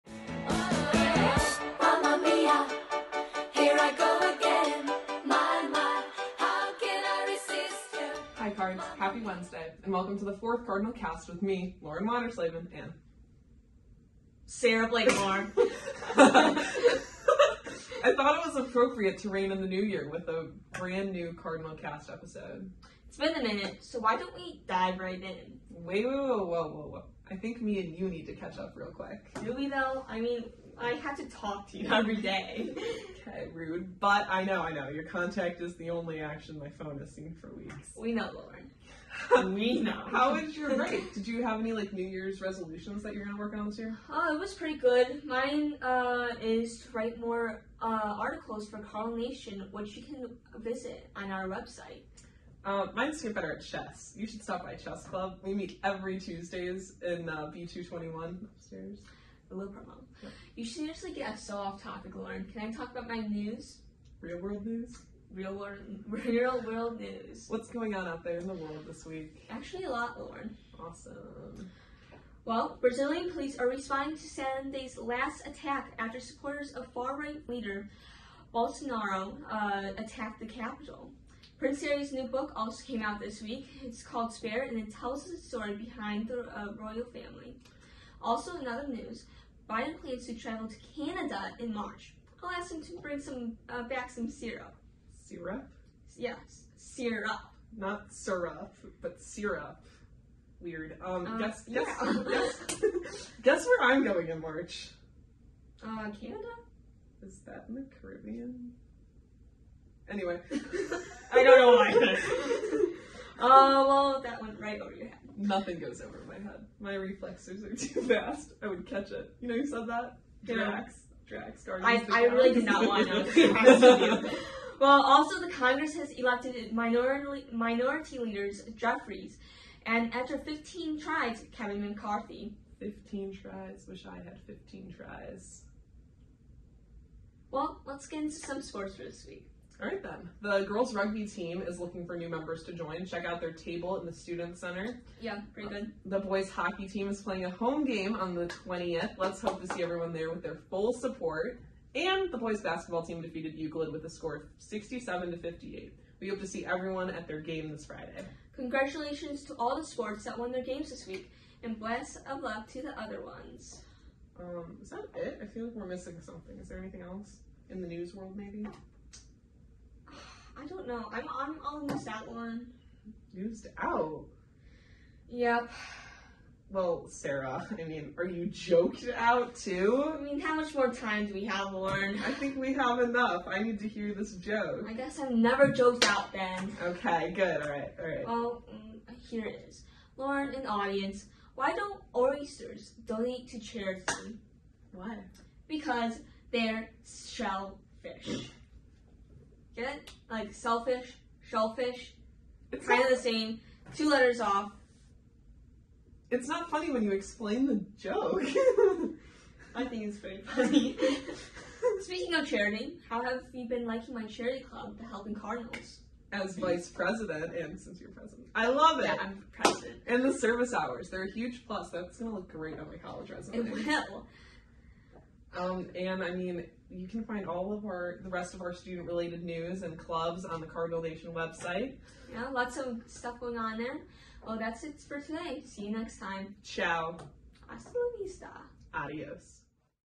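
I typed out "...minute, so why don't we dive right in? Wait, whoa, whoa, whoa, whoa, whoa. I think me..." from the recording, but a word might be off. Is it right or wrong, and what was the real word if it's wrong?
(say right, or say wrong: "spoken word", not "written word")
right.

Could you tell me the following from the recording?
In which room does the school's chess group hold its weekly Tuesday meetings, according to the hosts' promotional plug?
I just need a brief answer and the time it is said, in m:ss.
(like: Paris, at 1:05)
B221, at 0:57.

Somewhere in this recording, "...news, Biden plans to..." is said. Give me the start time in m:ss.
1:28.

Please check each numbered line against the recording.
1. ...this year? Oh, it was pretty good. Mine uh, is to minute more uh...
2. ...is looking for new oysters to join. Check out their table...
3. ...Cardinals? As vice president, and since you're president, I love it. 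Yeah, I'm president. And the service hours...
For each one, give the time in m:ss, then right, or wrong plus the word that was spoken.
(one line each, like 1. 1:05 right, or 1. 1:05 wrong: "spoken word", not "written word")
1. 0:43 wrong: "write", not "minute"
2. 2:21 wrong: "members", not "oysters"
3. 3:35 right.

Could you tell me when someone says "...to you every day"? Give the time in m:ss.
0:31.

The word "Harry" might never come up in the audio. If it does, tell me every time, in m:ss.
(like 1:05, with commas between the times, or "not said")
1:21.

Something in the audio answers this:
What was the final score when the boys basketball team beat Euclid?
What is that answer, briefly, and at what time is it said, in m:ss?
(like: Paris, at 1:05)
67 to 58, at 2:34.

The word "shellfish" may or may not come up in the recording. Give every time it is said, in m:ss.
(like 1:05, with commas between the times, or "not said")
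3:17, 3:21.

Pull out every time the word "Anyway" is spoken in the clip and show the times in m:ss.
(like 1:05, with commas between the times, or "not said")
1:50.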